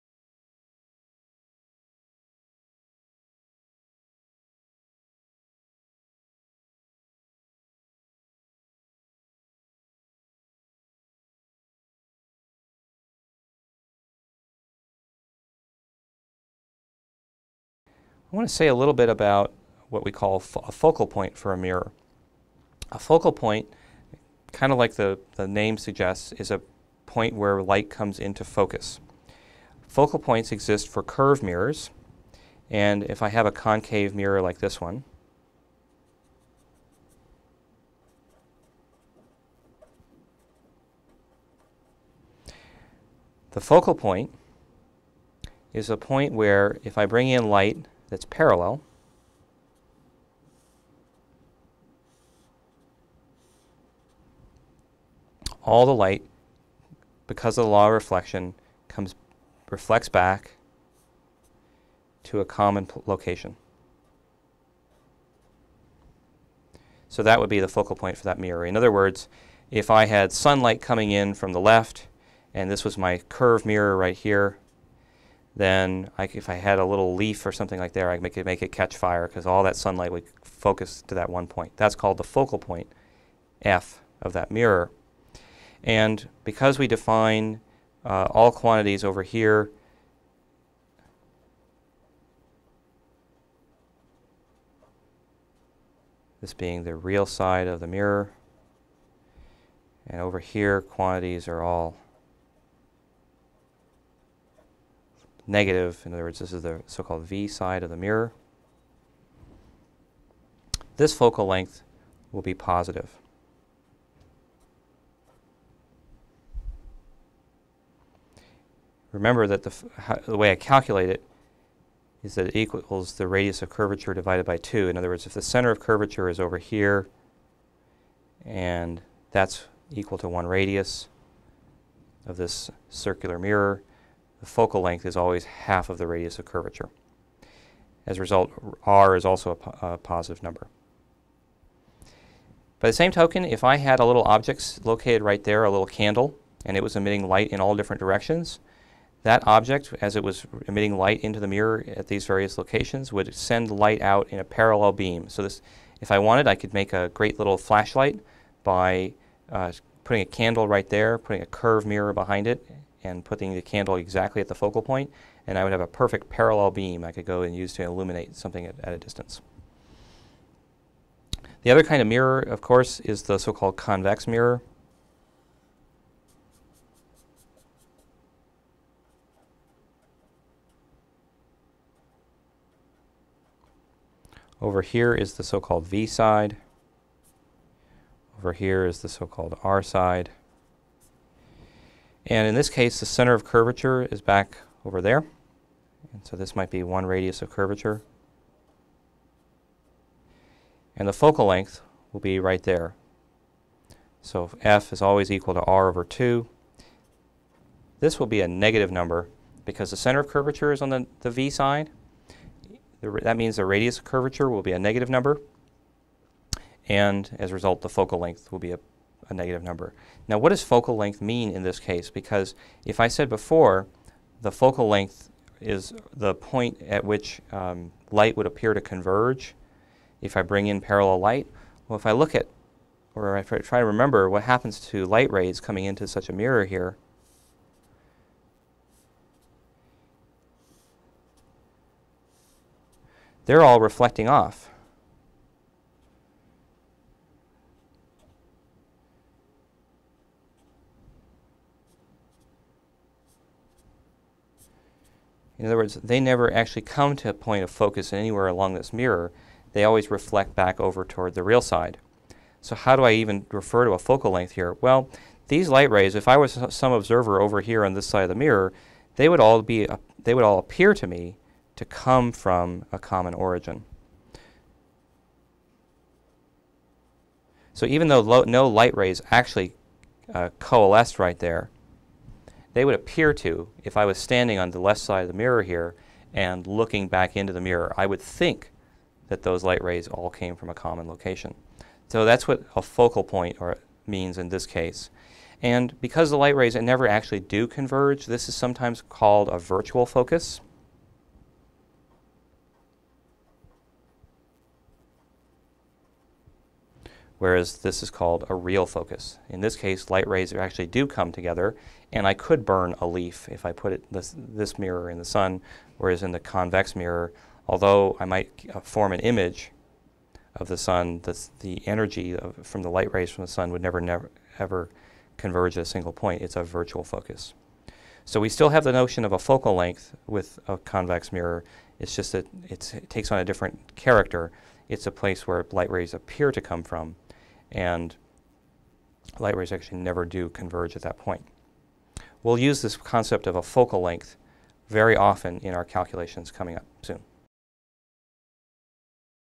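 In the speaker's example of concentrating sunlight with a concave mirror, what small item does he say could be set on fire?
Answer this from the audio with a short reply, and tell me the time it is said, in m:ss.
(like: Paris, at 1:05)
a leaf, at 1:16.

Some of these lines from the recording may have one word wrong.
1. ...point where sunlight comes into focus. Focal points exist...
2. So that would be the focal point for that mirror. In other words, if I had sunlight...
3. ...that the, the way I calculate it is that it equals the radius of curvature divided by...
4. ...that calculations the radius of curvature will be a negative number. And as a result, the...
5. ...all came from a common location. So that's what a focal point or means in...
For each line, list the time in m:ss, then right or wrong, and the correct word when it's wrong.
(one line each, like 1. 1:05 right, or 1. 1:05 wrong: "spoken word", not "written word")
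1. 0:27 wrong: "light", not "sunlight"
2. 1:07 right
3. 1:59 right
4. 3:33 wrong: "means", not "calculations"
5. 4:50 right.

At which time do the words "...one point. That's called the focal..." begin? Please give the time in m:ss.
1:21.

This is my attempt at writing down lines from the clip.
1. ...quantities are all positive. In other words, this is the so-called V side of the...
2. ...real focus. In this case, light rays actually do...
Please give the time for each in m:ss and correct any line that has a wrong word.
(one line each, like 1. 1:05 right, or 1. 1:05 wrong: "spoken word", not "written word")
1. 1:40 wrong: "negative", not "positive"
2. 5:08 right.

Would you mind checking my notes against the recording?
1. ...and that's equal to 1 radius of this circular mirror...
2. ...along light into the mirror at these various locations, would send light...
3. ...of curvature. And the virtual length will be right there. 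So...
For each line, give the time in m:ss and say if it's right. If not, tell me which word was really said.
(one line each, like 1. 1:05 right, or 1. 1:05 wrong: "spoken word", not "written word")
1. 2:08 right
2. 2:30 wrong: "emitting", not "along"
3. 3:17 wrong: "focal", not "virtual".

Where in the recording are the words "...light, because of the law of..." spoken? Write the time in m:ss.
0:55.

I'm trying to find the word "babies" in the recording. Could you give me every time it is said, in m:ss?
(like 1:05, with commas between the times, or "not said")
not said.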